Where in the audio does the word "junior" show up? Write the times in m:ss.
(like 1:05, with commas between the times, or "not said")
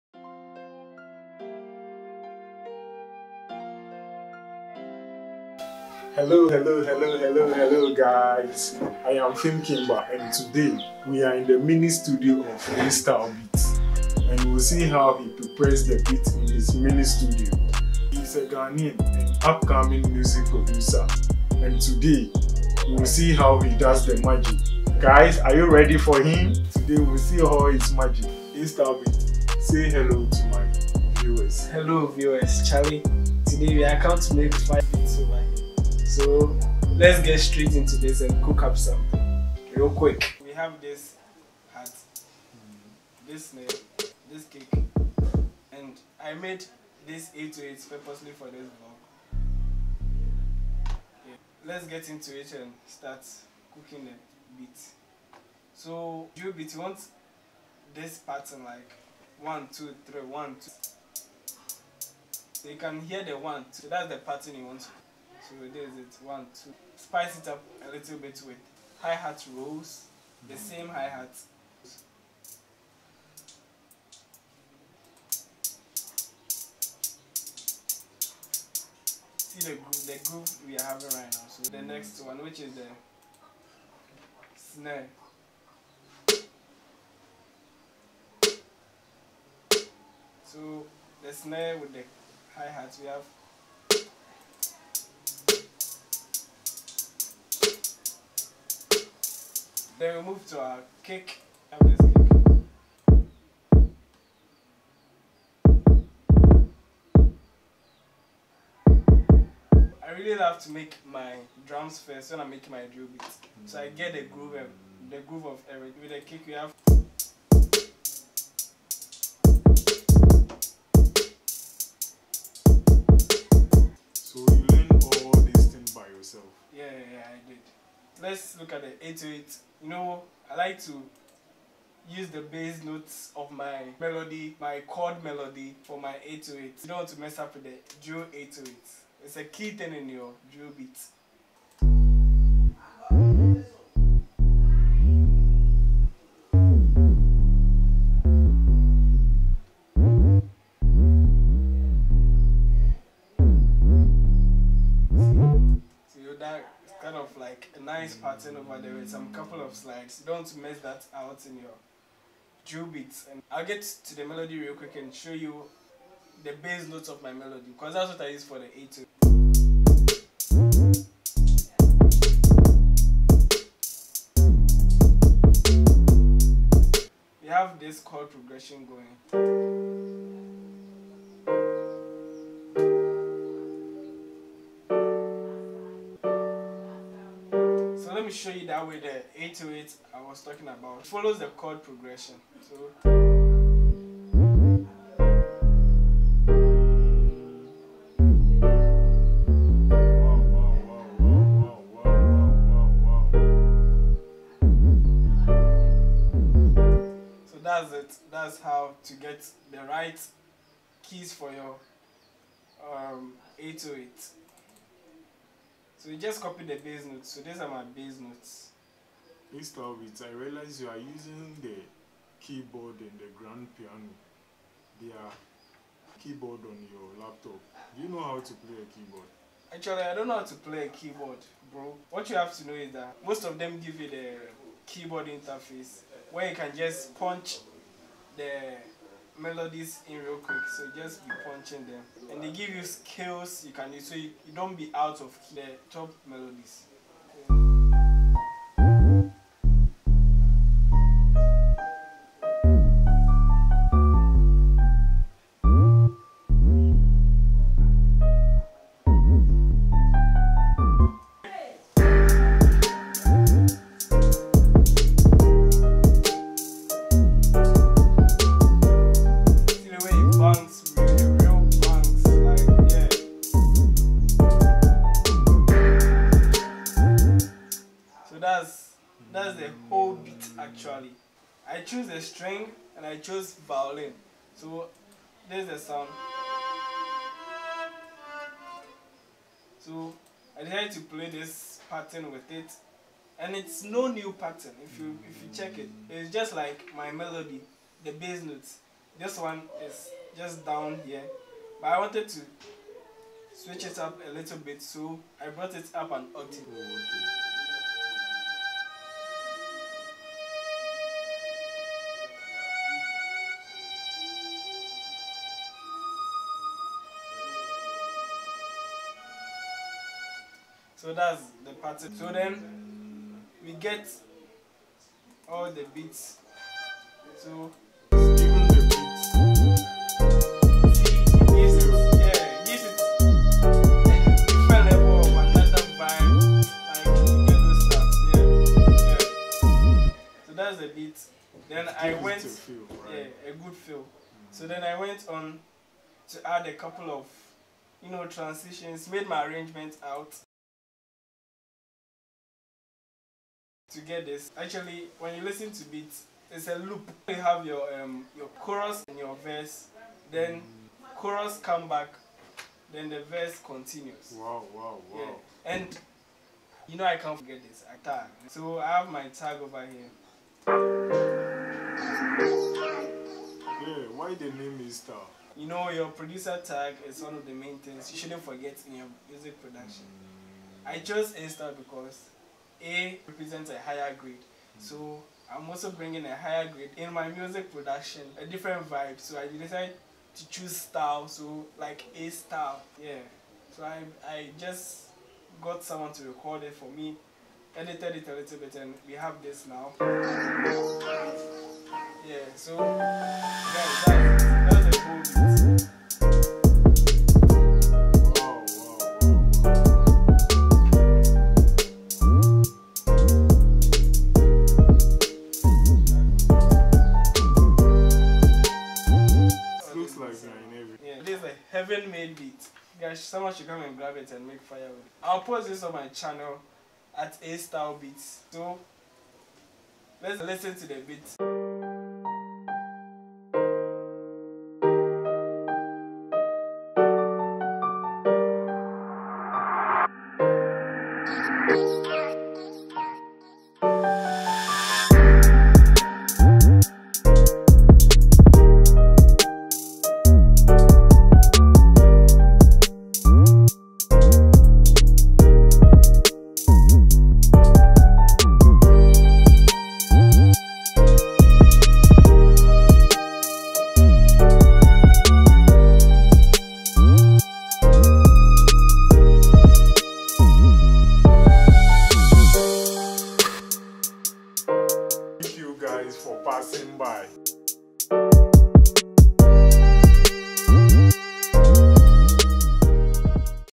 not said.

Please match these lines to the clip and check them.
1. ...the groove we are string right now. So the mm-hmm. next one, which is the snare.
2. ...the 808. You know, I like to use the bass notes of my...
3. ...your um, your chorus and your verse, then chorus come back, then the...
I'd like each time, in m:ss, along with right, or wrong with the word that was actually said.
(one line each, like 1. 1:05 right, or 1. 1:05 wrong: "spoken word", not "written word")
1. 1:20 wrong: "having", not "string"
2. 2:08 right
3. 5:57 right.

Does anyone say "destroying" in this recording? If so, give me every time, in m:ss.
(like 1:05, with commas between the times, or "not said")
not said.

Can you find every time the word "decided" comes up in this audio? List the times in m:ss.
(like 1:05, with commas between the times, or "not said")
4:50, 6:29.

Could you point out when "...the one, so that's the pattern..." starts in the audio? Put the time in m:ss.
1:03.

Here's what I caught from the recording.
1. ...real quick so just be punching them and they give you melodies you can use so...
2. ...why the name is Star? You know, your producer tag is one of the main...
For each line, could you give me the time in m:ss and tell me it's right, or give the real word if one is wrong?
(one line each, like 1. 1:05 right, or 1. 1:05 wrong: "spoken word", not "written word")
1. 4:00 wrong: "scales", not "melodies"
2. 6:14 right.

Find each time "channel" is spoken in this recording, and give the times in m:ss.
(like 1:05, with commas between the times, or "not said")
7:06.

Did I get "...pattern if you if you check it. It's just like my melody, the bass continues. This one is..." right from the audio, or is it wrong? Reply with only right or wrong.
wrong.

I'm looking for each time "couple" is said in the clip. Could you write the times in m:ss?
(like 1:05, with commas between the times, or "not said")
2:39, 5:46.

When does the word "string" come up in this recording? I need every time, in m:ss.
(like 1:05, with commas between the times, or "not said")
4:42.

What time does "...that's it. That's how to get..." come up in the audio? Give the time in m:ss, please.
3:27.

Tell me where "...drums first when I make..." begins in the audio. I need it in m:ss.
1:51.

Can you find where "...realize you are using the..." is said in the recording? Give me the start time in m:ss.
3:40.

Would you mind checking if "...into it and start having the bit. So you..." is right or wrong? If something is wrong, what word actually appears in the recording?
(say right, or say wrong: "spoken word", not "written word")
wrong: "cooking", not "having".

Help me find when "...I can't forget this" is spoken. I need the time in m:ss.
6:07.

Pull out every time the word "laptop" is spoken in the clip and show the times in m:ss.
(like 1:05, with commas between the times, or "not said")
3:47.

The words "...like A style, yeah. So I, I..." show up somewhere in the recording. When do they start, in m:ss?
6:31.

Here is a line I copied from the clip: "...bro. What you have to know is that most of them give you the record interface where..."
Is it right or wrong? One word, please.
wrong.